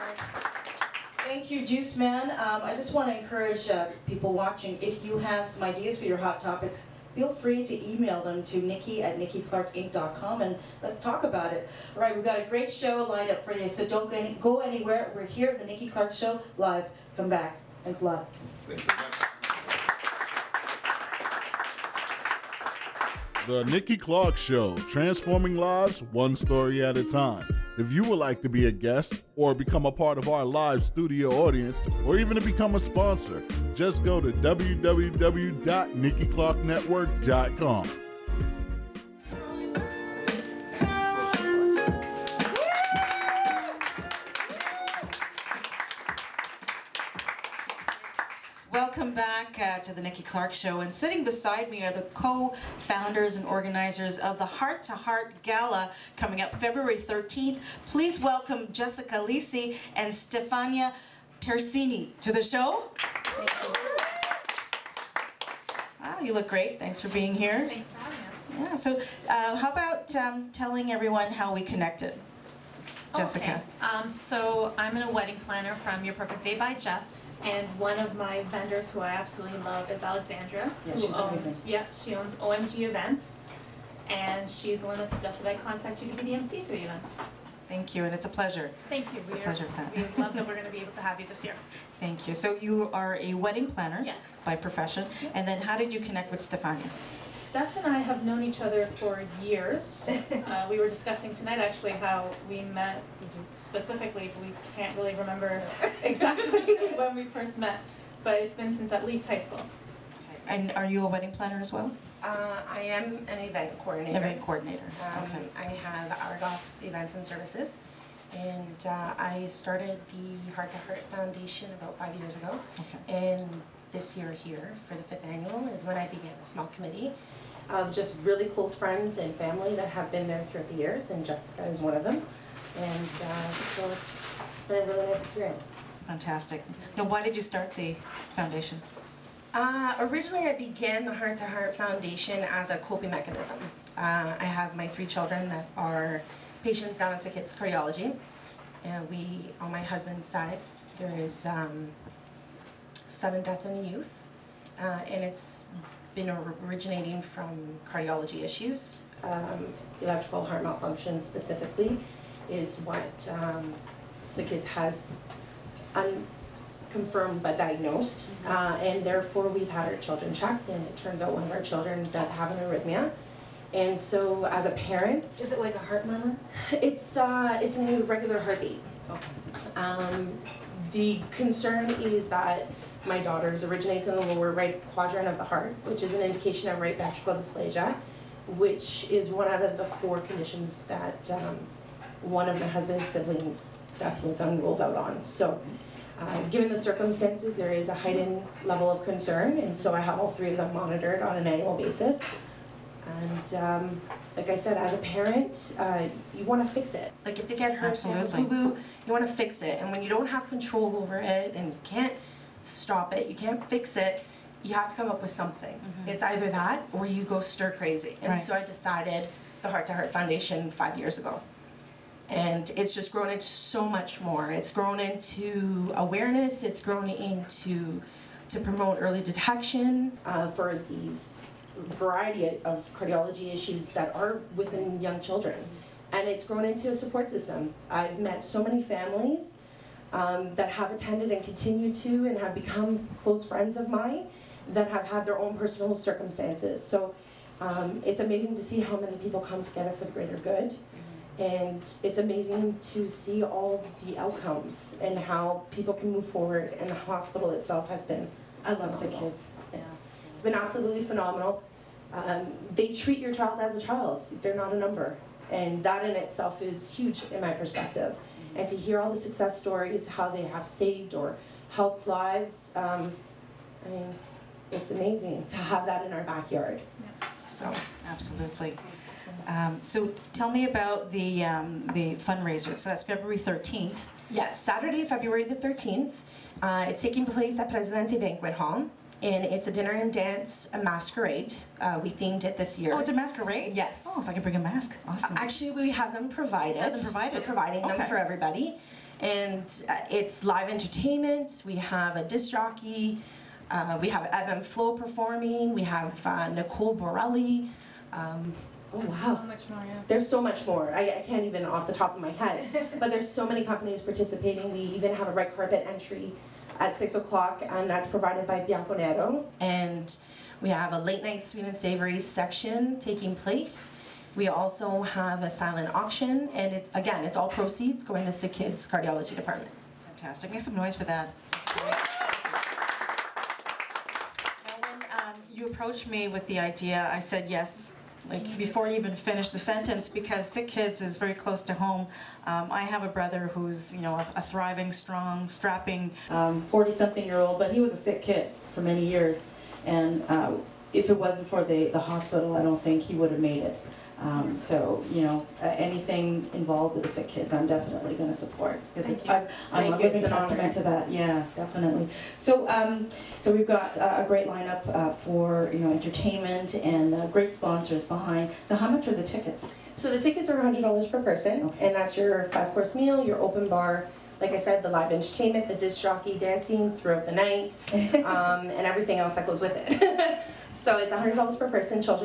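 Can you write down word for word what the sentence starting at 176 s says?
It's uh, it's an irregular heartbeat.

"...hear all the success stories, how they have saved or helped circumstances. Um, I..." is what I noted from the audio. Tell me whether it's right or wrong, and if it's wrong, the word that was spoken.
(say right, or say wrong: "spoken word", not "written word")
wrong: "lives", not "circumstances".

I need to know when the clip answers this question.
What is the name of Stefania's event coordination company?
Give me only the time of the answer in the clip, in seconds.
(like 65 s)
116 s.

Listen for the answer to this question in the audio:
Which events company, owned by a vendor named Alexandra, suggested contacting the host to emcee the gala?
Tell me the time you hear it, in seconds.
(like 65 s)
82 s.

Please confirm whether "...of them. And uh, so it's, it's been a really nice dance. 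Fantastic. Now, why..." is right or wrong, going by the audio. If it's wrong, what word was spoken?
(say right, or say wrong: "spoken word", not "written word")
wrong: "experience", not "dance".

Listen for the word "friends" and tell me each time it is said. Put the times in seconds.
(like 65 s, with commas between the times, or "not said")
128 s, 243 s.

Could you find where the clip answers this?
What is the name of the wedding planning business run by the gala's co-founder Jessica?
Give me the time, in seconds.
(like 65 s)
76 s.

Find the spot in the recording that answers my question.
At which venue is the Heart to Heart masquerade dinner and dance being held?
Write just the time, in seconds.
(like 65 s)
287 s.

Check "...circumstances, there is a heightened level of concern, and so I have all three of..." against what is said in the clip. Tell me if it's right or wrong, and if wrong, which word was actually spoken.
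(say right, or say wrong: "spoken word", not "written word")
right.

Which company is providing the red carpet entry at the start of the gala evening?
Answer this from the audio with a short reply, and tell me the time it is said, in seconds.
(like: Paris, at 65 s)
Bianconero, at 318 s.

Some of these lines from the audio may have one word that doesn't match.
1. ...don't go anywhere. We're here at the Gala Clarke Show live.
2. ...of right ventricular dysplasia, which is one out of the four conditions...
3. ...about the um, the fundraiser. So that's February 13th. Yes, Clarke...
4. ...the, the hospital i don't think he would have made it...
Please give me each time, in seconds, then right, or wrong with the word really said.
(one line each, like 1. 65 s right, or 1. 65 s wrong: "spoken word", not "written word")
1. 13 s wrong: "Nikki", not "Gala"
2. 186 s right
3. 280 s wrong: "Saturday", not "Clarke"
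4. 351 s right.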